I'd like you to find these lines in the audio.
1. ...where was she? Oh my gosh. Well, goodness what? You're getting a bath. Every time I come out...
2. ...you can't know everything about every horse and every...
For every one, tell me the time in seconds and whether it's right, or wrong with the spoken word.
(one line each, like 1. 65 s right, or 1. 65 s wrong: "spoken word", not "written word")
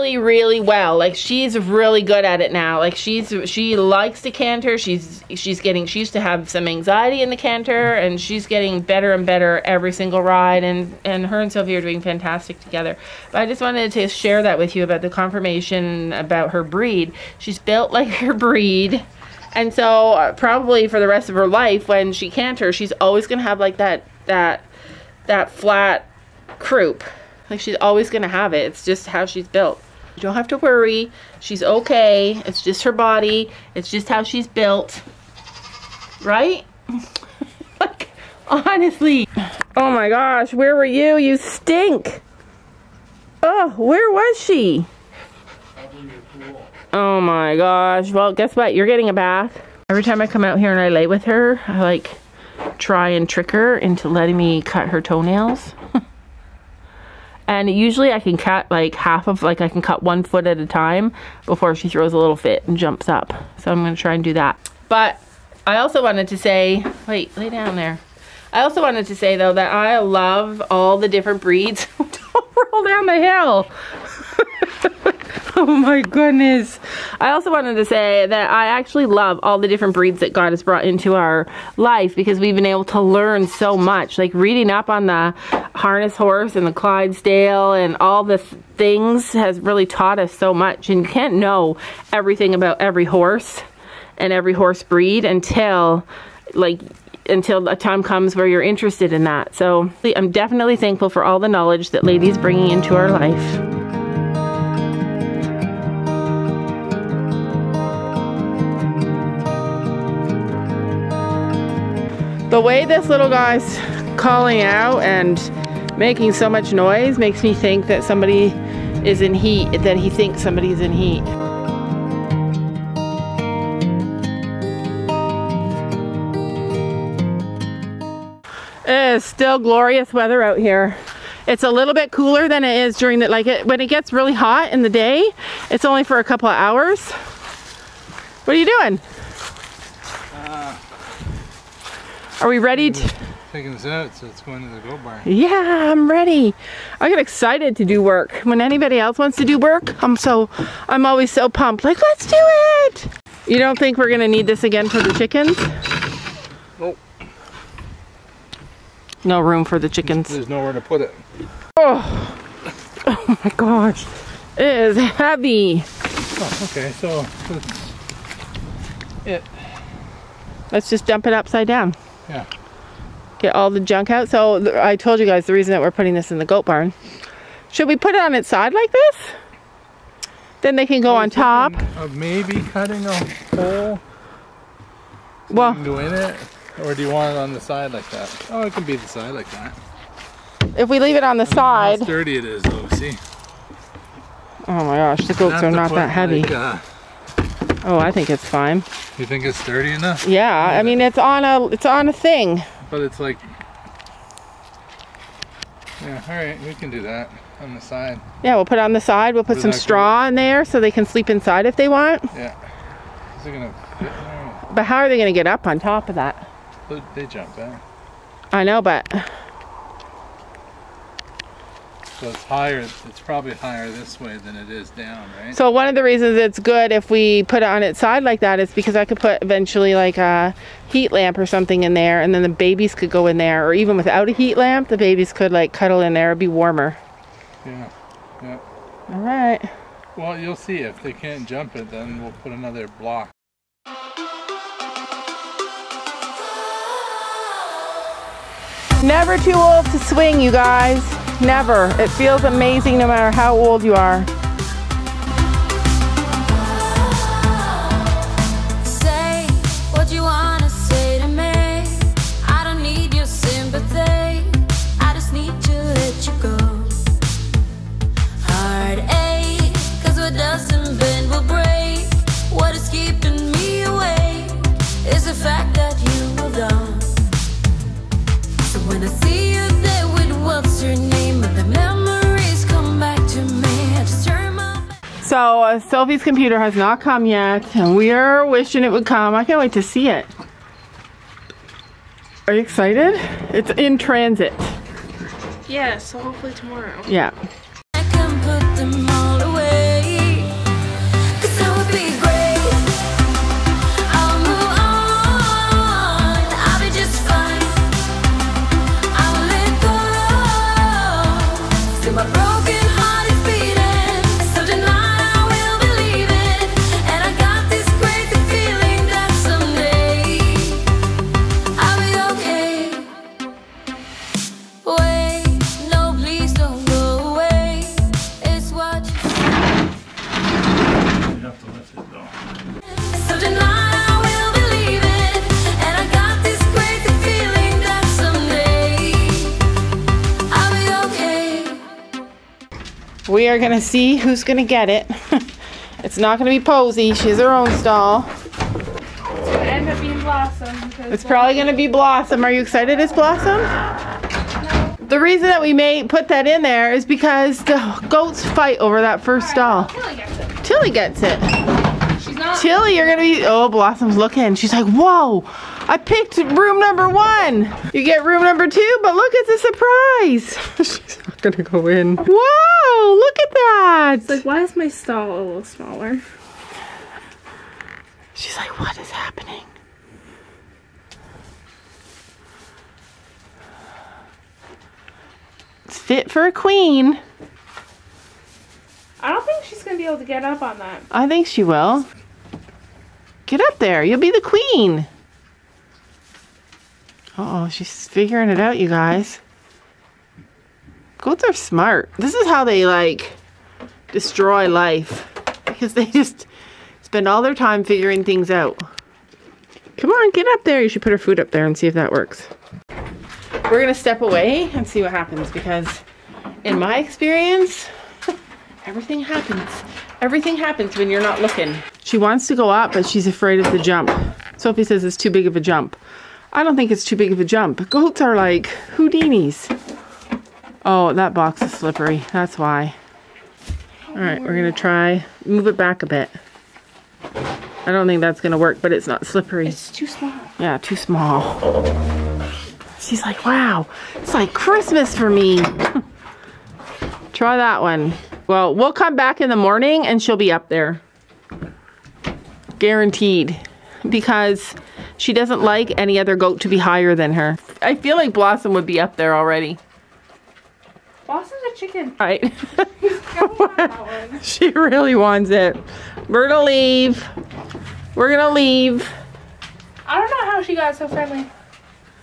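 1. 43 s wrong: "guess", not "goodness"
2. 91 s right.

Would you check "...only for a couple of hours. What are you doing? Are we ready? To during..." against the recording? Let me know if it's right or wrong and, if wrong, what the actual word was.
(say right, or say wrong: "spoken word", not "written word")
wrong: "taking", not "during".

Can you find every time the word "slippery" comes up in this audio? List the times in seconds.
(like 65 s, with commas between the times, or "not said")
431 s, 439 s.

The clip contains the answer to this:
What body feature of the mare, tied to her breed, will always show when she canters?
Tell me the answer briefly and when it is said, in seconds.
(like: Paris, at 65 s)
Flat croup, at 25 s.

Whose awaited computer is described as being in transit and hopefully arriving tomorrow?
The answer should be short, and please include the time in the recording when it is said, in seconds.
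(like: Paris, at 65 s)
Sylvie, at 285 s.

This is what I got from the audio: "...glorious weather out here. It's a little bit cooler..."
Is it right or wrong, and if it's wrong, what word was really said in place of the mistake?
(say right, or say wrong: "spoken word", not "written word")
right.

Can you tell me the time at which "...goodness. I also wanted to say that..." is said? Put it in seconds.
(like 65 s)
76 s.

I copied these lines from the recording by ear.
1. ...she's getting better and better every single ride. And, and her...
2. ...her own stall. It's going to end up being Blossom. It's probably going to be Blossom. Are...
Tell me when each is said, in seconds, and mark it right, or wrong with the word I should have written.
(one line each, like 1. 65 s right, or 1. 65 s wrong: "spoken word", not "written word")
1. 8 s right
2. 347 s right.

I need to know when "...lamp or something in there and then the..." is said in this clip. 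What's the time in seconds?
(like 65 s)
231 s.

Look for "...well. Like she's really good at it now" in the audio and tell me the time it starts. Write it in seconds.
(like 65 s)
0 s.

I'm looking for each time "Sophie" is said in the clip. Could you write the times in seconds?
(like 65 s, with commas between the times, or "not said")
11 s, 424 s.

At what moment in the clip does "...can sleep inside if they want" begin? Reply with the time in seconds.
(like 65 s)
210 s.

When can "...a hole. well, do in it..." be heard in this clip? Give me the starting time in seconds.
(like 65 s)
183 s.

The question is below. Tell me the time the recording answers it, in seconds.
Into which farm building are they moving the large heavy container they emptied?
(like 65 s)
176 s.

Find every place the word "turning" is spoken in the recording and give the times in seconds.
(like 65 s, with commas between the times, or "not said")
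not said.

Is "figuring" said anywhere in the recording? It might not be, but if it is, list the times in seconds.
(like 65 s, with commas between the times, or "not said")
398 s, 407 s.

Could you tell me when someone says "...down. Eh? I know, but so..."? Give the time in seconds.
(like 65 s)
217 s.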